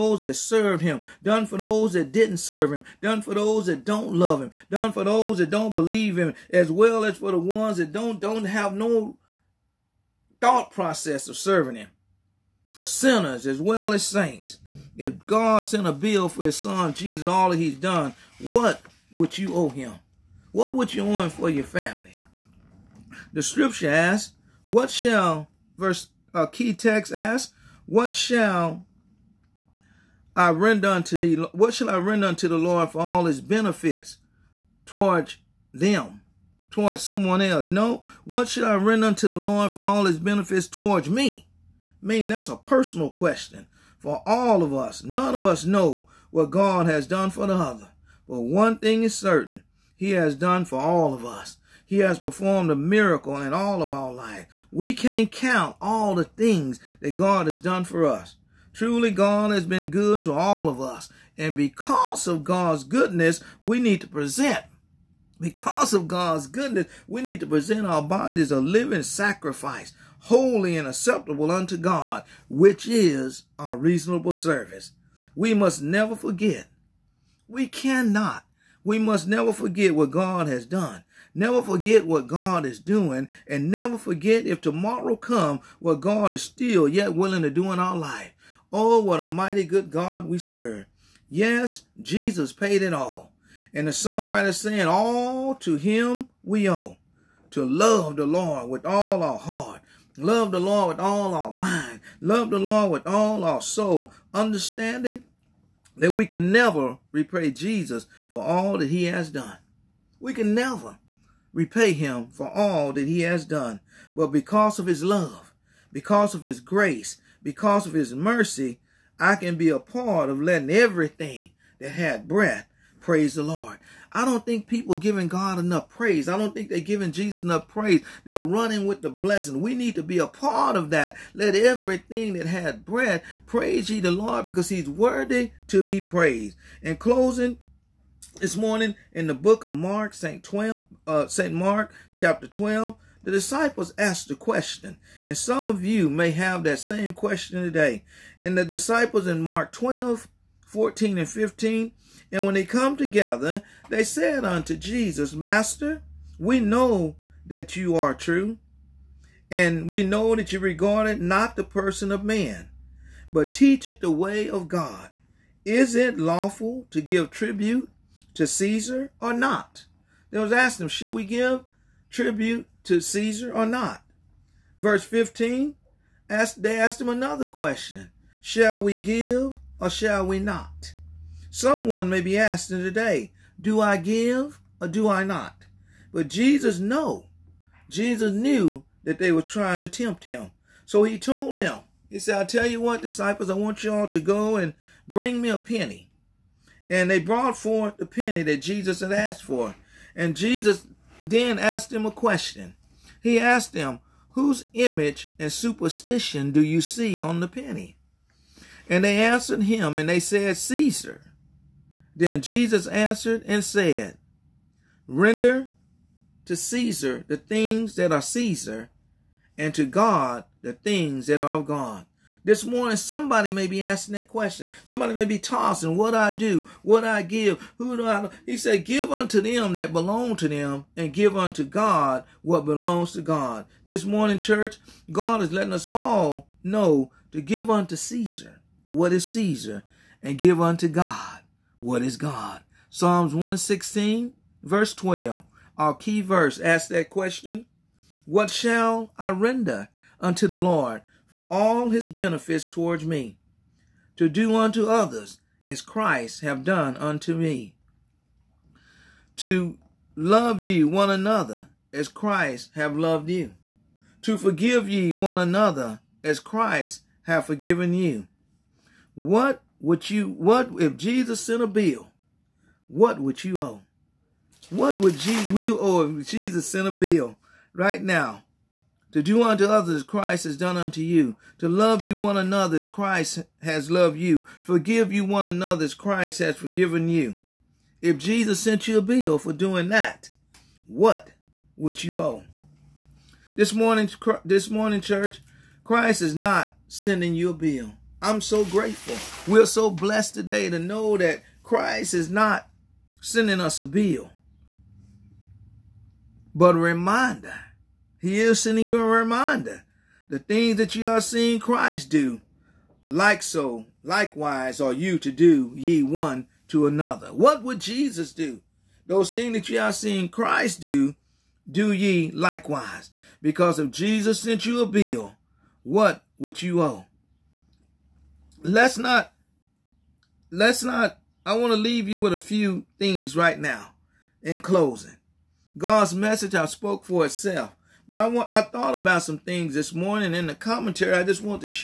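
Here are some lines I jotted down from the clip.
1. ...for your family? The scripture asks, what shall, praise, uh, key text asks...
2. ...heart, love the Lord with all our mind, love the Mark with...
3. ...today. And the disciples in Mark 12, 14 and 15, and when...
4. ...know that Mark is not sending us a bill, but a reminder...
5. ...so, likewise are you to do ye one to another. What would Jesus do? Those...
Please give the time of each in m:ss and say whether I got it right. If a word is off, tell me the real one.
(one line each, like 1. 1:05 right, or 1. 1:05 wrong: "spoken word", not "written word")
1. 0:21 wrong: "verse", not "praise"
2. 1:39 wrong: "Lord", not "Mark"
3. 2:27 right
4. 5:00 wrong: "Christ", not "Mark"
5. 5:13 right.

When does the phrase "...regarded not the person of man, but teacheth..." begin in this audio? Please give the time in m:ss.
2:40.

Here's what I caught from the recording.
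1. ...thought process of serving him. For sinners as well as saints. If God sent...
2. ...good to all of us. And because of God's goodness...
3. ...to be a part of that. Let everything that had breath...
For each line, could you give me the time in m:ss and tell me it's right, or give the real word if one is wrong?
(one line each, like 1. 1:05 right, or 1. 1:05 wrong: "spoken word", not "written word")
1. 0:10 right
2. 0:59 right
3. 2:09 right.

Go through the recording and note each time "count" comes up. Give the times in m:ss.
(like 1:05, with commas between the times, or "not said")
0:55.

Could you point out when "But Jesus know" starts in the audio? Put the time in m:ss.
3:06.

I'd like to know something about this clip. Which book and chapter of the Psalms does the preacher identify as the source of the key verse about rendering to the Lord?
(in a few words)
Psalms 116.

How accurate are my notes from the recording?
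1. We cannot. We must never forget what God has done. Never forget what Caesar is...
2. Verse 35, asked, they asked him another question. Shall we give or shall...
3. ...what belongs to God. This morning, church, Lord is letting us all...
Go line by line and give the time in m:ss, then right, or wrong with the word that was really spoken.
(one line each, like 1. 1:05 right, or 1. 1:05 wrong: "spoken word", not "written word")
1. 1:17 wrong: "God", not "Caesar"
2. 2:54 wrong: "15", not "35"
3. 3:52 wrong: "God", not "Lord".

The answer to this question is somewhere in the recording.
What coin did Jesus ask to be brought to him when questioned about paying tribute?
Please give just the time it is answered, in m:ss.
3:15.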